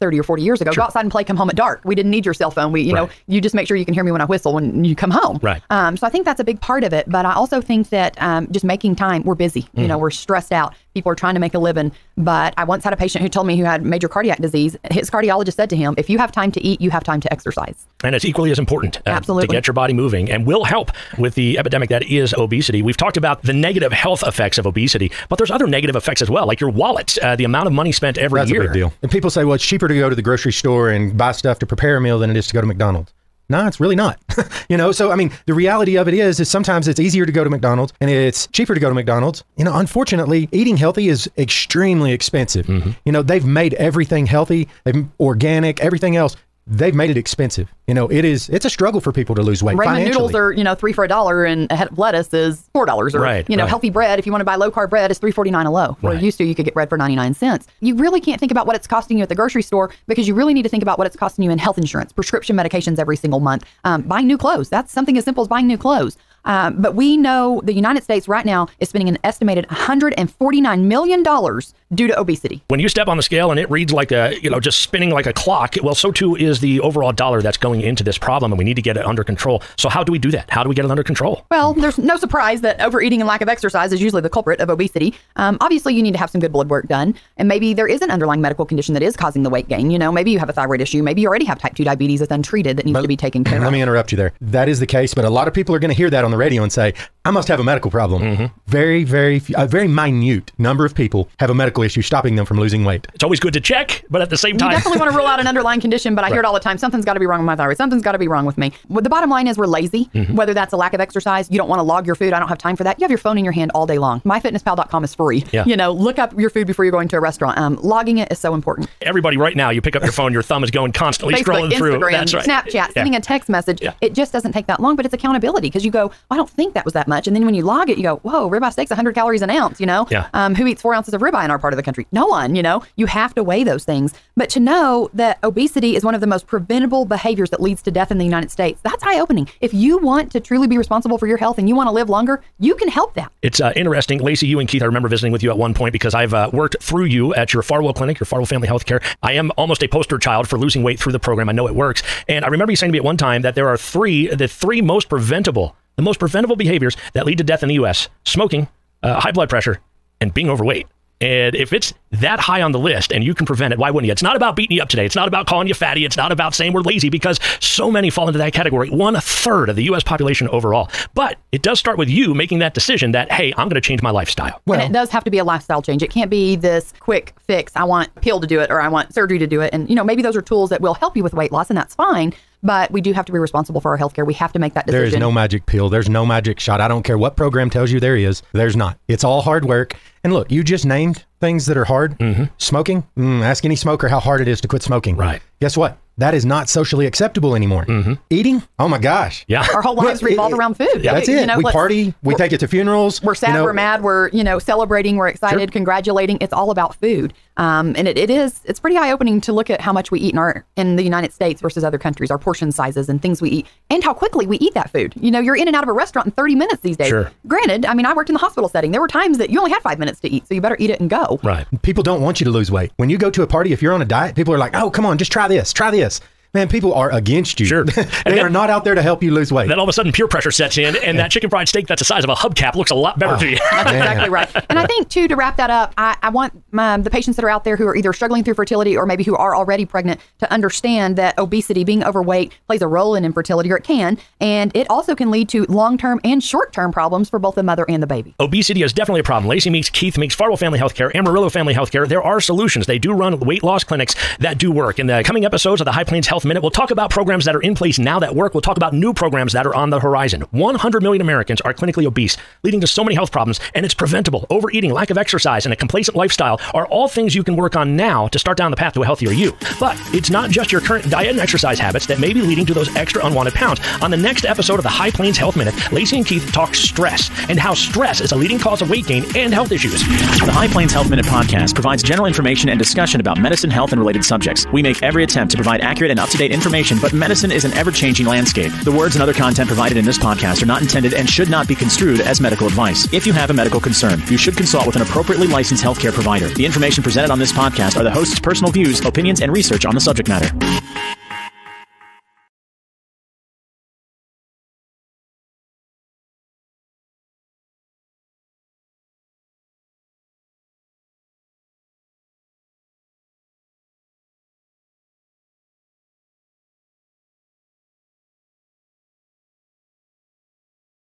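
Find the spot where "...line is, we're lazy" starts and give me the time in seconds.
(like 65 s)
109 s.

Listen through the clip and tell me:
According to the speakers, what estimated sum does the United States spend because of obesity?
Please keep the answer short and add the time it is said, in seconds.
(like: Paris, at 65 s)
149 million dollars, at 69 s.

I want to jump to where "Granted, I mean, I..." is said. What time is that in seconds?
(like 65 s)
217 s.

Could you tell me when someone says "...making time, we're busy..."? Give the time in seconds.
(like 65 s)
8 s.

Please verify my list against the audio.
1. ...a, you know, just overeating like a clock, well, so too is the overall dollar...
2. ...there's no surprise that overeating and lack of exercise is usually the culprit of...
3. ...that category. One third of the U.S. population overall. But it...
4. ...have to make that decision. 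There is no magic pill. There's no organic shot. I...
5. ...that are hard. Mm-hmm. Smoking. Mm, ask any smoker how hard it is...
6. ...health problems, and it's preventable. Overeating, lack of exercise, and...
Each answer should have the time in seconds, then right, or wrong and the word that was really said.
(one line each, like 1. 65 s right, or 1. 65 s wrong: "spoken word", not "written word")
1. 74 s wrong: "spinning", not "overeating"
2. 81 s right
3. 168 s right
4. 184 s wrong: "magic", not "organic"
5. 191 s right
6. 263 s right.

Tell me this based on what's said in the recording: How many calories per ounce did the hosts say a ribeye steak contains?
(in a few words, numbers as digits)
100.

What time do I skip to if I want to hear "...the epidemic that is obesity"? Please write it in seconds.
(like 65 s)
21 s.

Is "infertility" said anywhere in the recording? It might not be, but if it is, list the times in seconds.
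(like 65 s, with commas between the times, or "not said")
243 s.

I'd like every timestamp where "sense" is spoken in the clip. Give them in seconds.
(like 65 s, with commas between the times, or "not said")
not said.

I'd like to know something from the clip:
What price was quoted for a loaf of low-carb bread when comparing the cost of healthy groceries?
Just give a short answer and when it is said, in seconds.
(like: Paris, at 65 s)
$3.49, at 55 s.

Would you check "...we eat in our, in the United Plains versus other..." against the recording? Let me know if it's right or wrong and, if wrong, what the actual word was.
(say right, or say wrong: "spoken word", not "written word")
wrong: "States", not "Plains".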